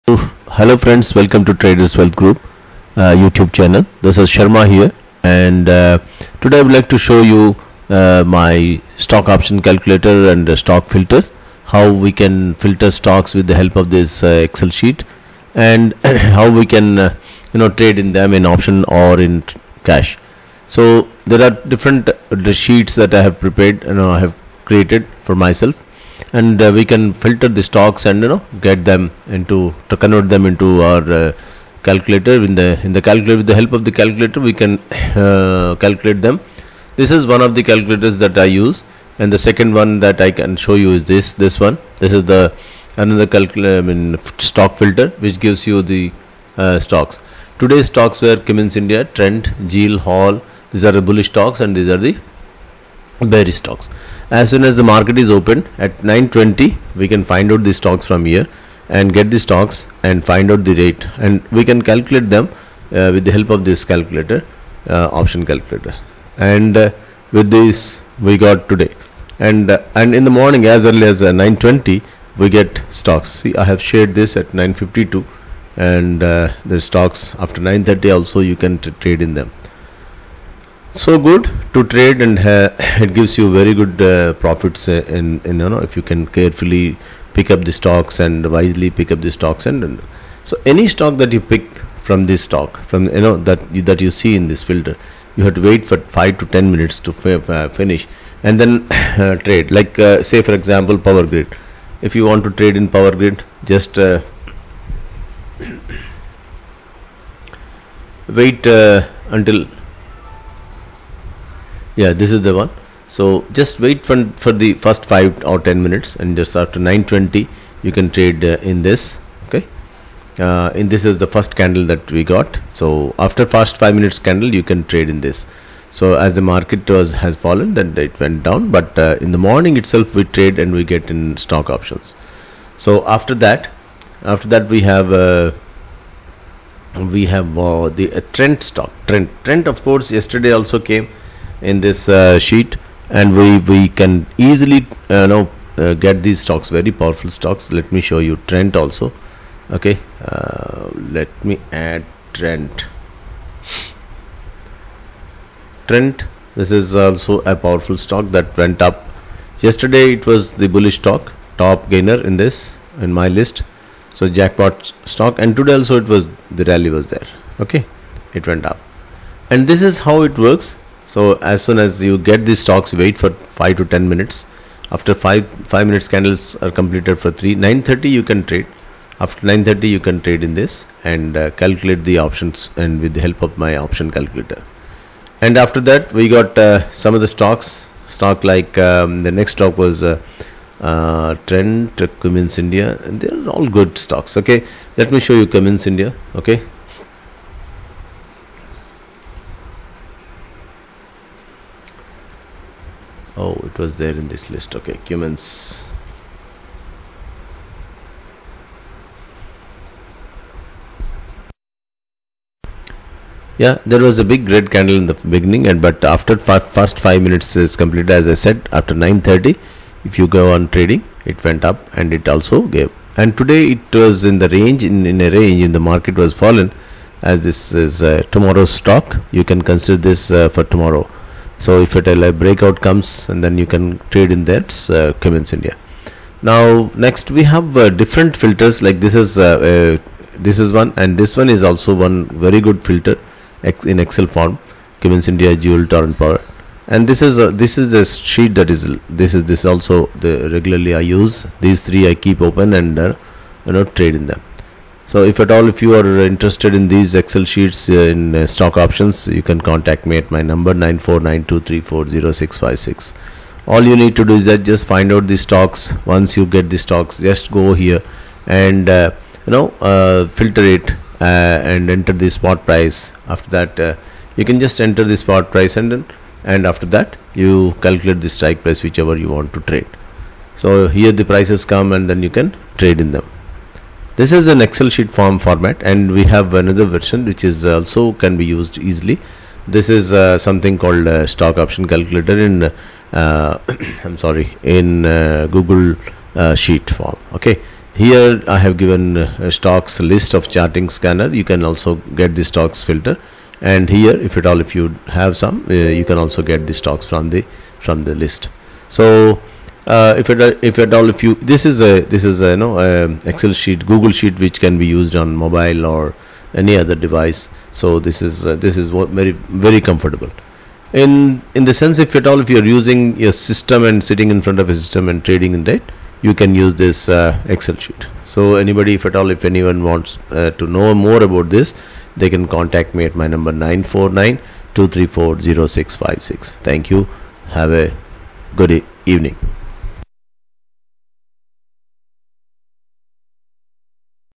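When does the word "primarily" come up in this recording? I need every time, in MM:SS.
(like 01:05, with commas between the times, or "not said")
not said.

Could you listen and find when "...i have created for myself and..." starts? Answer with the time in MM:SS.
00:24.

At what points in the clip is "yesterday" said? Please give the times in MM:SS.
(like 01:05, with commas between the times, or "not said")
02:20, 02:39.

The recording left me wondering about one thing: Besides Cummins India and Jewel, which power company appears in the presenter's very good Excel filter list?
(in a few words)
Torrent Power.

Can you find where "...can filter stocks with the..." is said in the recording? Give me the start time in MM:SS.
00:12.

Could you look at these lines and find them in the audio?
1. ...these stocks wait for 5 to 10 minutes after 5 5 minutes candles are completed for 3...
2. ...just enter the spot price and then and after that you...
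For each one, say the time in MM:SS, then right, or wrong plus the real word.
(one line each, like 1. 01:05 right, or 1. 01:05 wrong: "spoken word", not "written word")
1. 02:52 right
2. 04:34 right.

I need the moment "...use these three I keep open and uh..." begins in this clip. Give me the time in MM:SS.
04:11.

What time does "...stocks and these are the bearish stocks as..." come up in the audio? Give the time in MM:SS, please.
00:51.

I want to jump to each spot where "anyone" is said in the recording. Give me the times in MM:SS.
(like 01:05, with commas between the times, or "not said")
05:29.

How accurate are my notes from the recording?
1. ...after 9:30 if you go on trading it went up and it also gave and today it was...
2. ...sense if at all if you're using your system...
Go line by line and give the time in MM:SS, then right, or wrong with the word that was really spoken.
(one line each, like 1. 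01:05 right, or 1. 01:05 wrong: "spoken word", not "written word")
1. 03:38 right
2. 05:21 right.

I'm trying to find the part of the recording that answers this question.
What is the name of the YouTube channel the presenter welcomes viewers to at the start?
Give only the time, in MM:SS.
00:01.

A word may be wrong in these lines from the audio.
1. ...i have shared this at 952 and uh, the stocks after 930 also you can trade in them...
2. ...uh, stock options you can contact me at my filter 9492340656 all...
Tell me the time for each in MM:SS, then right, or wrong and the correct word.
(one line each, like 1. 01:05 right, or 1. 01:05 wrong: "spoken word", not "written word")
1. 01:13 right
2. 04:18 wrong: "number", not "filter".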